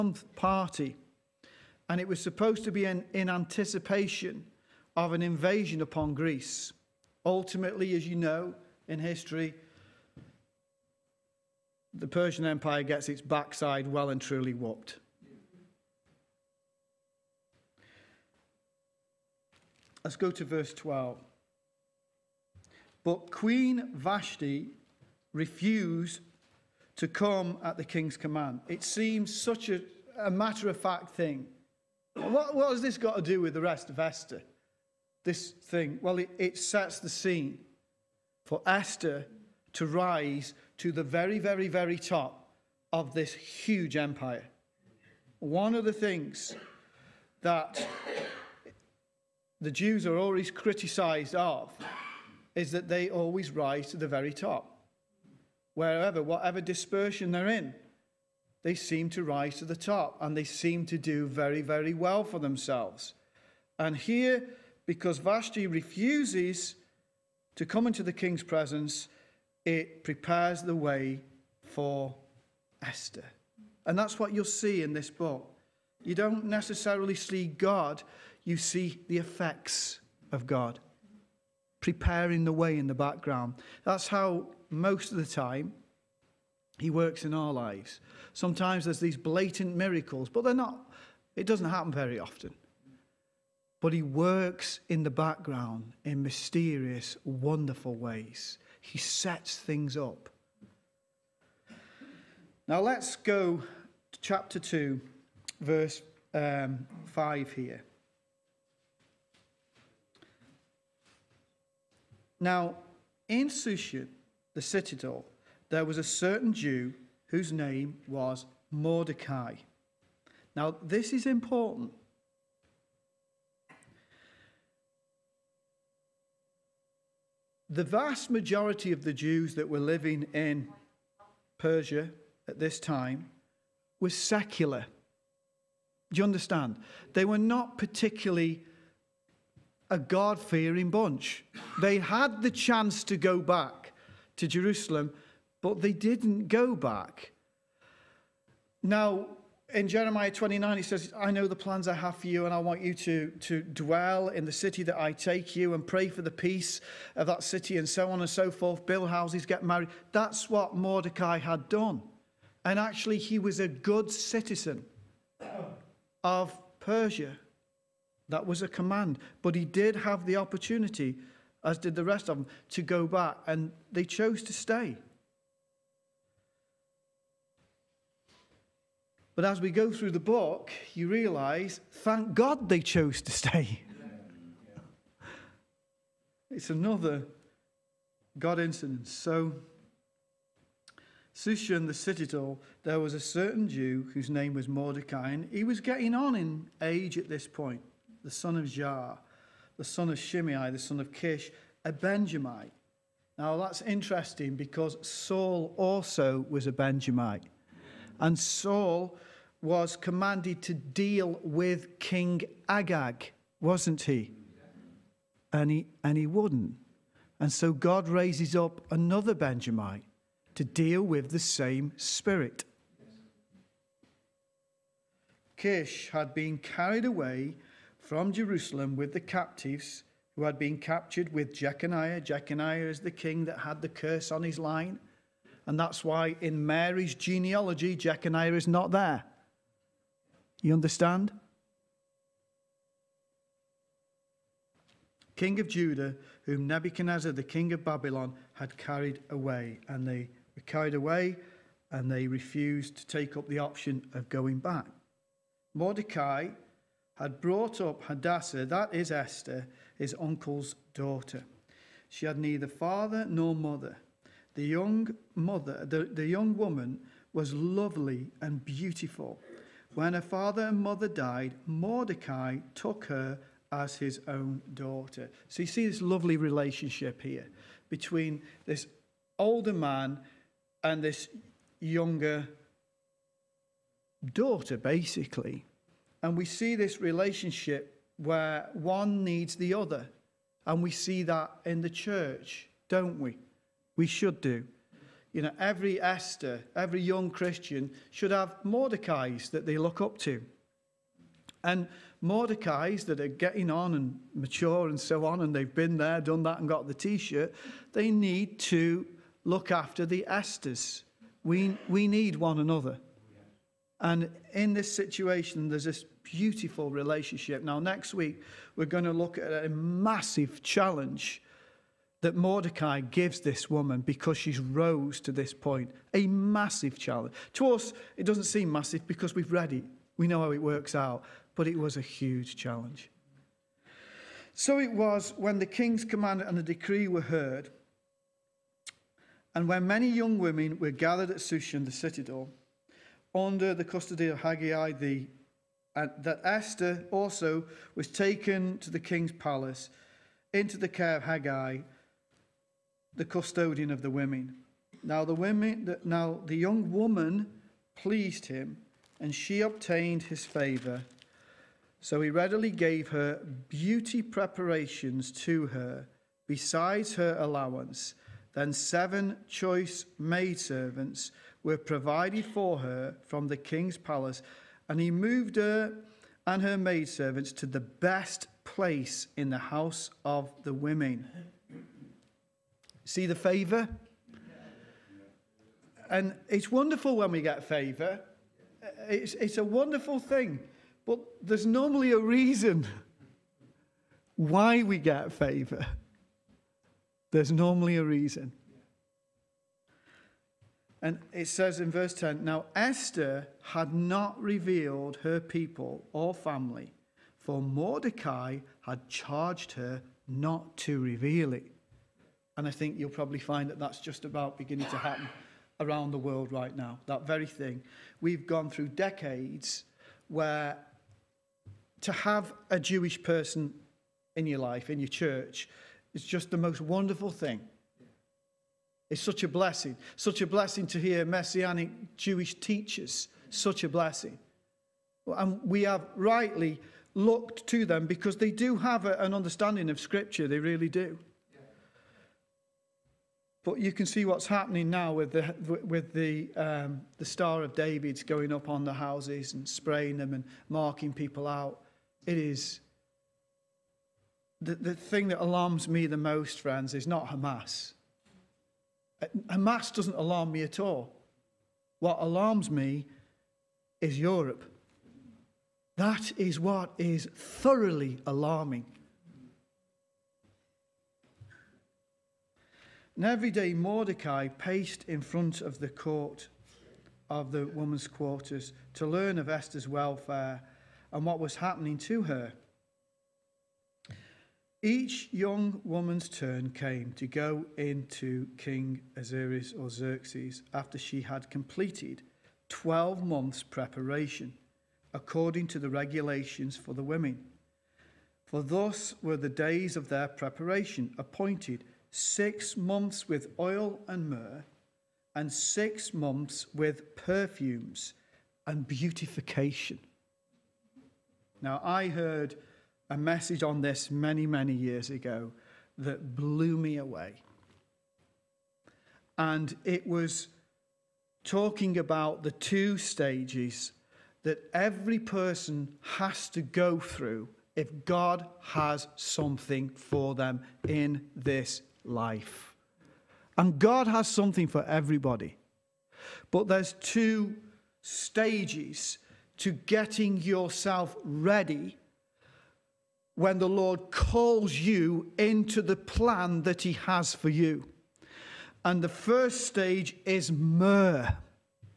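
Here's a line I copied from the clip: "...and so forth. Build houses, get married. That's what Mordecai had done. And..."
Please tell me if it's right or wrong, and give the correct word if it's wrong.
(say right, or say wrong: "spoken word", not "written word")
right.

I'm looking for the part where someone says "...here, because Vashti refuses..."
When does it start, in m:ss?
1:03.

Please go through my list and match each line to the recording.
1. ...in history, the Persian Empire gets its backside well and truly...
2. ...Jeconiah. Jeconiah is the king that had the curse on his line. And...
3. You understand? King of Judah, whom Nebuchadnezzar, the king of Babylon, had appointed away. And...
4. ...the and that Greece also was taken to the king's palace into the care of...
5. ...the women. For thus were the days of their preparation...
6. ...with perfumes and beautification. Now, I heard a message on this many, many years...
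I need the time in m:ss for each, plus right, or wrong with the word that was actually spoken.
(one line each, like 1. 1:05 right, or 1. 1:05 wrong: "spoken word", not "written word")
1. 0:08 right
2. 3:51 right
3. 4:00 wrong: "carried", not "appointed"
4. 5:44 wrong: "Esther", not "Greece"
5. 8:16 right
6. 8:26 right.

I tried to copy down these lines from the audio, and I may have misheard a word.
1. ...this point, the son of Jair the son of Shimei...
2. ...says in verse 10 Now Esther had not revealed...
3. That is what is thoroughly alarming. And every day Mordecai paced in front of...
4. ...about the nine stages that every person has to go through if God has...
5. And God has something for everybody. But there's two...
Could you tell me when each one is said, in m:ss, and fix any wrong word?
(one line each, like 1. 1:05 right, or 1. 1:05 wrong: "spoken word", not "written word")
1. 3:17 right
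2. 6:41 right
3. 7:45 right
4. 8:41 wrong: "two", not "nine"
5. 8:53 right.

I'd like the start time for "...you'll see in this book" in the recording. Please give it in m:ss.
1:14.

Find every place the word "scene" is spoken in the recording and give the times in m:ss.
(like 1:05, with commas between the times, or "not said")
0:37.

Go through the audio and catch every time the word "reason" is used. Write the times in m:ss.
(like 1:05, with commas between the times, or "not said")
6:32, 6:38.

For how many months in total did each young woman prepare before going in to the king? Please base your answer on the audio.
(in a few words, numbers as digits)
12.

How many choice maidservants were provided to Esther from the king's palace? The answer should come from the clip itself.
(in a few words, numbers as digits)
7.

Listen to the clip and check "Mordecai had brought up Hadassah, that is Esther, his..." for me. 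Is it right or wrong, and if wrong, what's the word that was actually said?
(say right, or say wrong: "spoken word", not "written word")
right.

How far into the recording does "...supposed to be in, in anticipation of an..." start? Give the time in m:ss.
0:02.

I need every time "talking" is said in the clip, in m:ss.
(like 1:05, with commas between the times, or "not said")
8:41.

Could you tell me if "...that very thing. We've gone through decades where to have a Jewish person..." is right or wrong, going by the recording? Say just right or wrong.
right.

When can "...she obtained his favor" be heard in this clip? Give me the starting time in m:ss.
5:59.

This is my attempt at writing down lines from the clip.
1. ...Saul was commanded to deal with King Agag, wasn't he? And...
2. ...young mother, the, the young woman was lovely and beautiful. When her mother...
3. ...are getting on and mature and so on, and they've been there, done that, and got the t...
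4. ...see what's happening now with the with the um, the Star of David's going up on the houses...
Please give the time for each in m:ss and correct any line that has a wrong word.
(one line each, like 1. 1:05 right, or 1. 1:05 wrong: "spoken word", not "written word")
1. 3:28 right
2. 4:24 wrong: "father", not "mother"
3. 5:03 right
4. 7:24 right.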